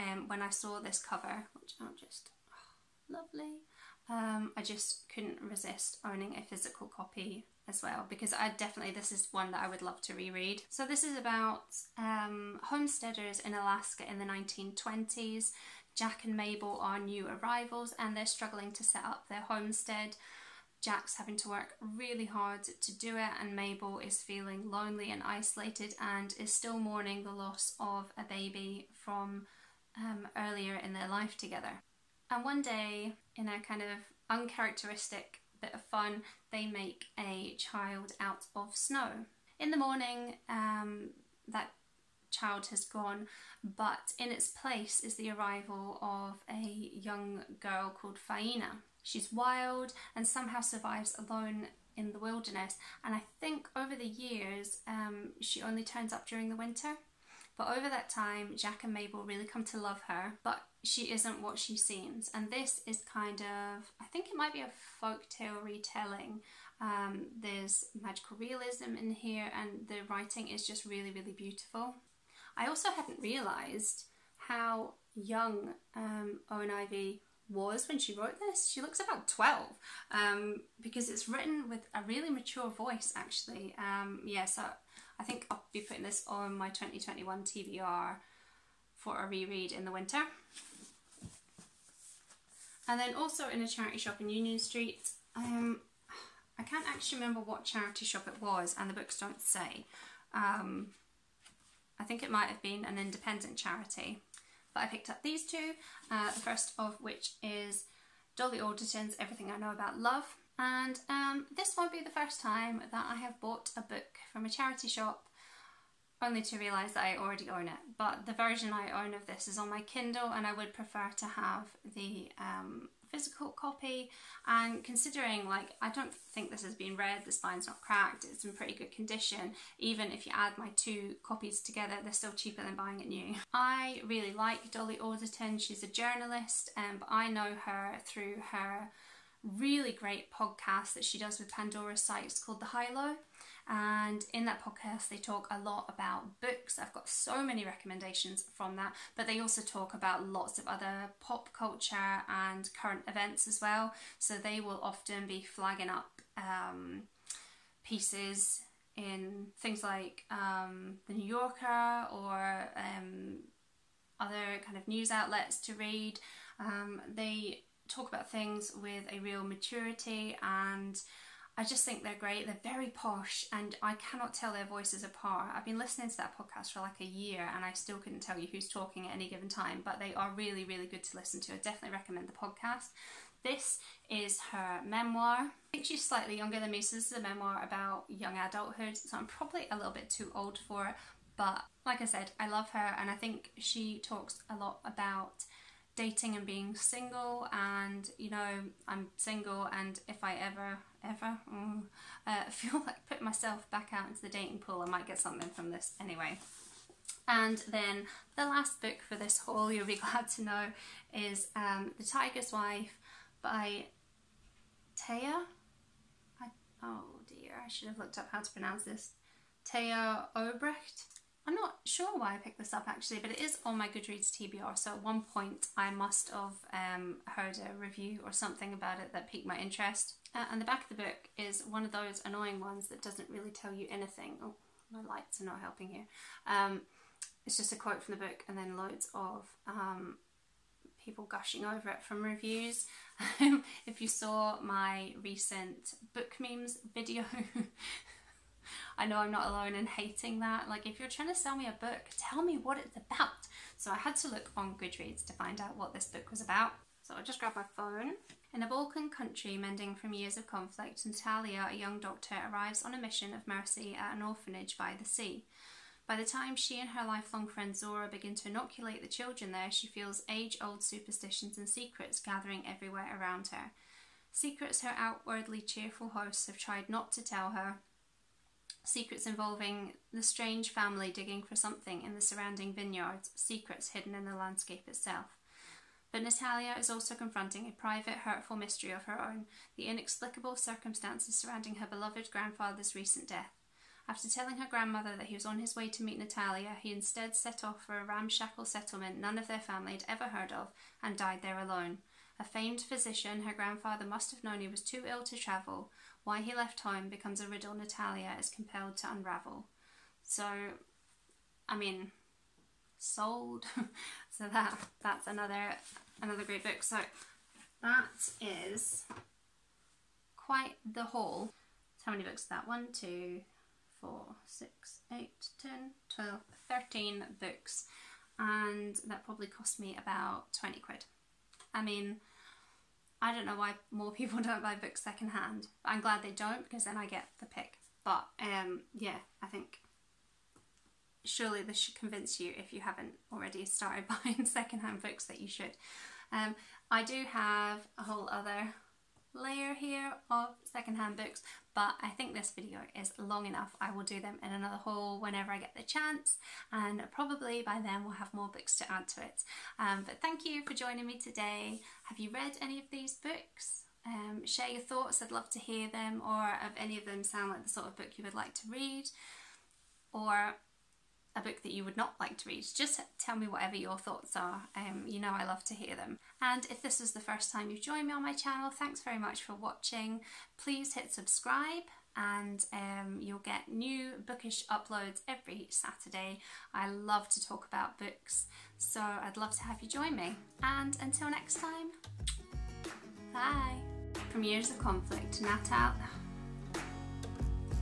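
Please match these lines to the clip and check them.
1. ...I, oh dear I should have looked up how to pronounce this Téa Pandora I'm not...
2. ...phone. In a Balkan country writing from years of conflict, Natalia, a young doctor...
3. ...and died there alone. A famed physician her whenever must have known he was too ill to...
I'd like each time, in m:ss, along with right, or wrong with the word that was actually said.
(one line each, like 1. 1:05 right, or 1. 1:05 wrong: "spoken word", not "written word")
1. 3:36 wrong: "Obreht", not "Pandora"
2. 4:17 wrong: "mending", not "writing"
3. 5:01 wrong: "grandfather", not "whenever".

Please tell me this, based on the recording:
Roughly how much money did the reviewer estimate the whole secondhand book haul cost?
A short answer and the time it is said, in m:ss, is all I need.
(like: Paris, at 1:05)
20 quid, at 5:30.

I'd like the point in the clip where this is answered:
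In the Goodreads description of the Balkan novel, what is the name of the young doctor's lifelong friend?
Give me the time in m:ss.
4:27.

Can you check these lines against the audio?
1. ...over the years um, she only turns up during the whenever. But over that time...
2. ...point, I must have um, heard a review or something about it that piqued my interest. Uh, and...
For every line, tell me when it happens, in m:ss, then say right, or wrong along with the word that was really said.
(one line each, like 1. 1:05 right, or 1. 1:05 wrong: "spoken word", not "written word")
1. 0:53 wrong: "winter", not "whenever"
2. 3:45 right.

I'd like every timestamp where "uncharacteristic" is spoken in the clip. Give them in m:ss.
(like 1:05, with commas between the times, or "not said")
0:34.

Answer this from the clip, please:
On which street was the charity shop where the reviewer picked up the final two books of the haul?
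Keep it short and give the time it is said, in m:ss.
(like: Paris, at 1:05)
Union Street, at 1:34.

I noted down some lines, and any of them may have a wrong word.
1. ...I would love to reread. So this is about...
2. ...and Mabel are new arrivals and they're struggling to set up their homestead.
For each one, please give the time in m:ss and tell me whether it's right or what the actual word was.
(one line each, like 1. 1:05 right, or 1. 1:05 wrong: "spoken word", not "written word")
1. 0:09 right
2. 0:16 right.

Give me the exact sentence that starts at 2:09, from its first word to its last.
Even if you add my two copies together, they're still cheaper than buying it new.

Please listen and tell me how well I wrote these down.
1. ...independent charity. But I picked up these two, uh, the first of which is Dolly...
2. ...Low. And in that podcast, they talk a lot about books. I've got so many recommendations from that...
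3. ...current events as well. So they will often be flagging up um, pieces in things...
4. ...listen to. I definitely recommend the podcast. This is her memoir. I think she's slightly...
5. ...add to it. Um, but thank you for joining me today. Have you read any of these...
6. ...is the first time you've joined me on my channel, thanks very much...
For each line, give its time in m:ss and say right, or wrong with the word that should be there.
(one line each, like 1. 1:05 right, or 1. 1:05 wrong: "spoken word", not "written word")
1. 1:42 right
2. 2:22 right
3. 2:32 right
4. 3:01 right
5. 5:58 right
6. 6:16 right.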